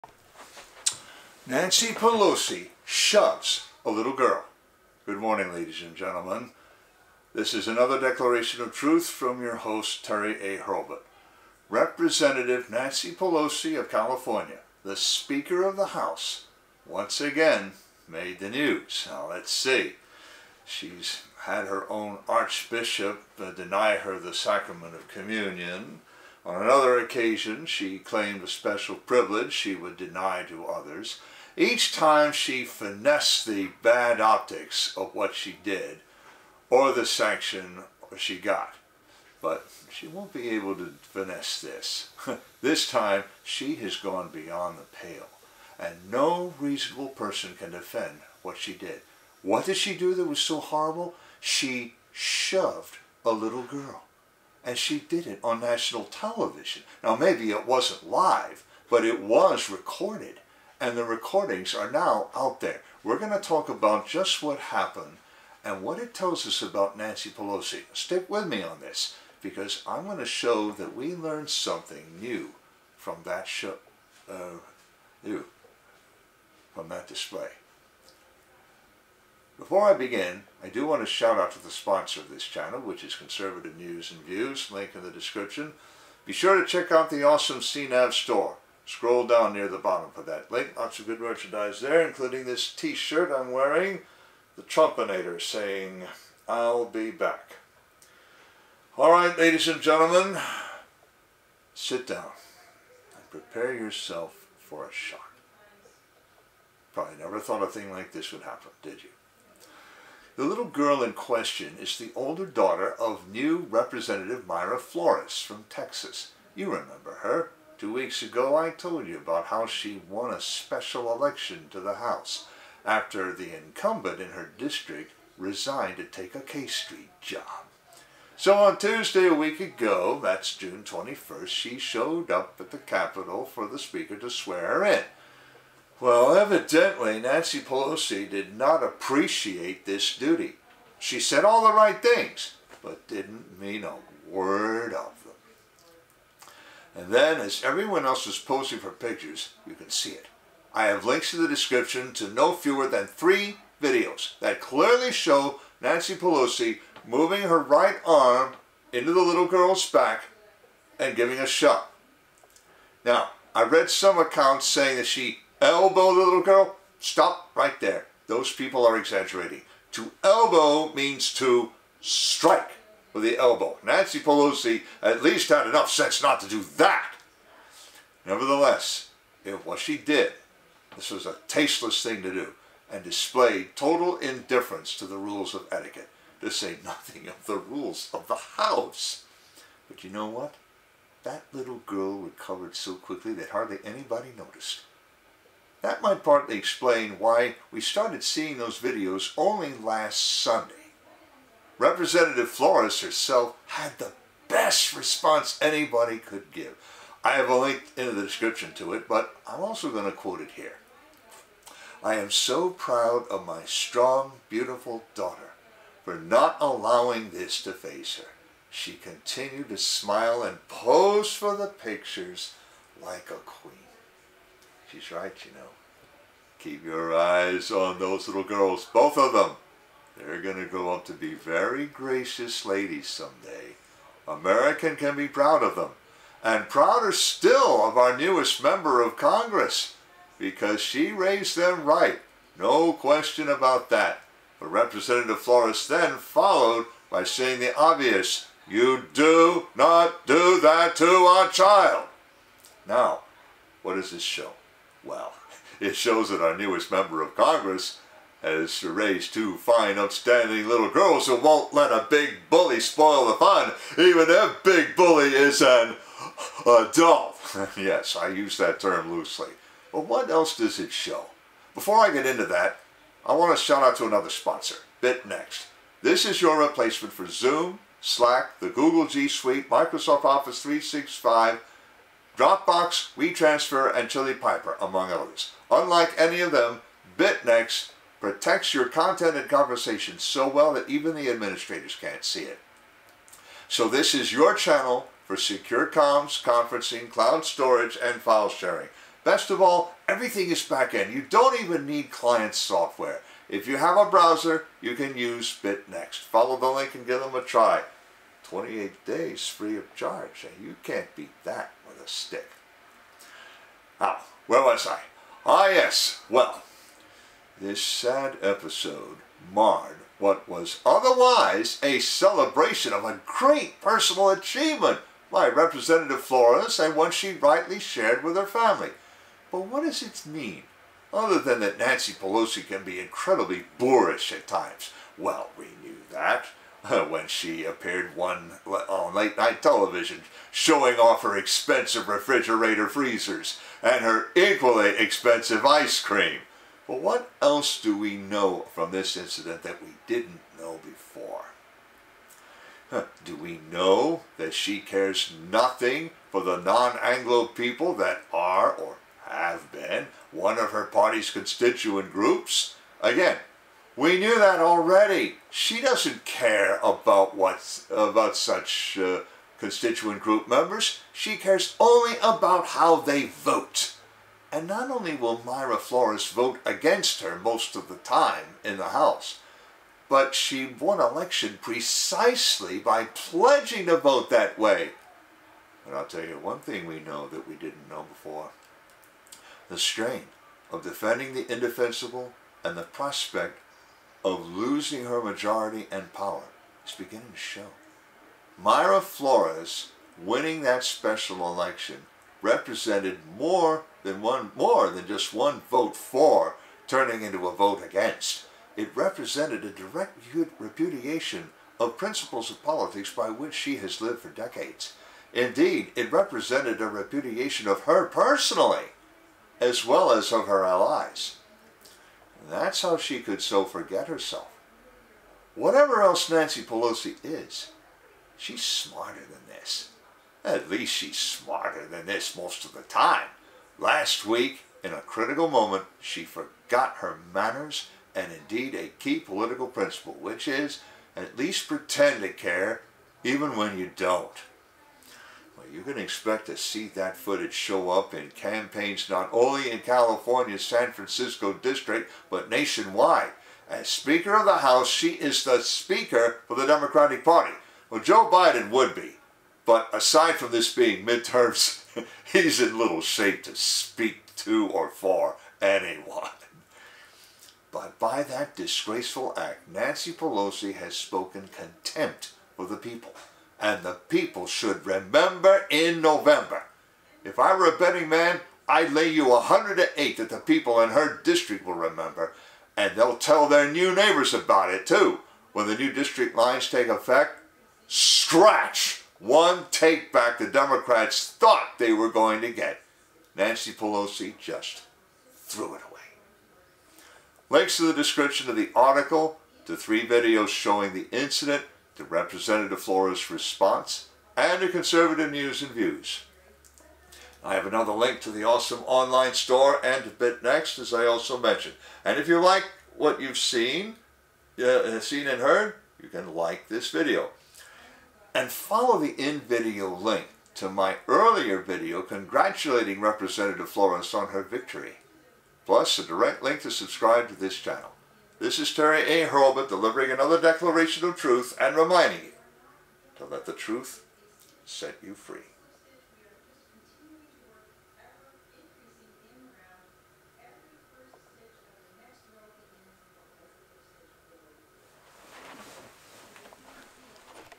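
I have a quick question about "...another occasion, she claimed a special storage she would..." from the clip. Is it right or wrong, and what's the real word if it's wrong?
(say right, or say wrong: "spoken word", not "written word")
wrong: "privilege", not "storage".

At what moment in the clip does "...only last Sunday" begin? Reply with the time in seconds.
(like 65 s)
199 s.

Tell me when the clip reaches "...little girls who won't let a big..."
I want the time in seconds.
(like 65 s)
260 s.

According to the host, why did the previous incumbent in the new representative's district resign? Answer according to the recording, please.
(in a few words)
To take a K Street job.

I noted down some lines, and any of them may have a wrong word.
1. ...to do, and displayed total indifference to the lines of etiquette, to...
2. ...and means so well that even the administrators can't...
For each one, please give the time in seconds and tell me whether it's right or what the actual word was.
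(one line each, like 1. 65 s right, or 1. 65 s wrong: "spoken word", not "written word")
1. 182 s wrong: "rules", not "lines"
2. 289 s wrong: "conversations", not "means".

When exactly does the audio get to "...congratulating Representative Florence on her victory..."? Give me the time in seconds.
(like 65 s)
522 s.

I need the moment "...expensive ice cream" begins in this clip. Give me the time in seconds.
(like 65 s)
344 s.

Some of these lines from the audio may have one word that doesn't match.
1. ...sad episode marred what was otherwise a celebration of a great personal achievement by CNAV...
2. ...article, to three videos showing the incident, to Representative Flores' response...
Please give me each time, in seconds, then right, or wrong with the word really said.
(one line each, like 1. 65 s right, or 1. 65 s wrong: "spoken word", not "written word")
1. 317 s wrong: "Representative", not "CNAV"
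2. 498 s right.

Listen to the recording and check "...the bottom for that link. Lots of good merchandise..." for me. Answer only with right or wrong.
right.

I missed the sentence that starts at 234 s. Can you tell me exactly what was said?
American can be proud of them.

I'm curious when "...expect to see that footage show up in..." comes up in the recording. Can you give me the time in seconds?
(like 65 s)
446 s.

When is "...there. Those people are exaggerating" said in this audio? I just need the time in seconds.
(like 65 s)
167 s.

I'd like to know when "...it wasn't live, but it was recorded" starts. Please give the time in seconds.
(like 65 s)
57 s.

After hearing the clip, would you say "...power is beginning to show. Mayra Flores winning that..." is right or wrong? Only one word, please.
right.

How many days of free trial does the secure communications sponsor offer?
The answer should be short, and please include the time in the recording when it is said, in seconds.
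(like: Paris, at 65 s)
28, at 308 s.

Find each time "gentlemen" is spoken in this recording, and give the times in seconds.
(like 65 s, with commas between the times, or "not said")
5 s, 99 s.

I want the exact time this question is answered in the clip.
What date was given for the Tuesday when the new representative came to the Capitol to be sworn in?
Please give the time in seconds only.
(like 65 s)
130 s.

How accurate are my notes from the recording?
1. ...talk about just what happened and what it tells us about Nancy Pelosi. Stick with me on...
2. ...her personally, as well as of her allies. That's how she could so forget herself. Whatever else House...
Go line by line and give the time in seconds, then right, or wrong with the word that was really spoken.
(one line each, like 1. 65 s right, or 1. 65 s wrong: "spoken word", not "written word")
1. 63 s right
2. 417 s wrong: "Nancy", not "House".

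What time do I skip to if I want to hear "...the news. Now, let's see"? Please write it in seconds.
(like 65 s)
18 s.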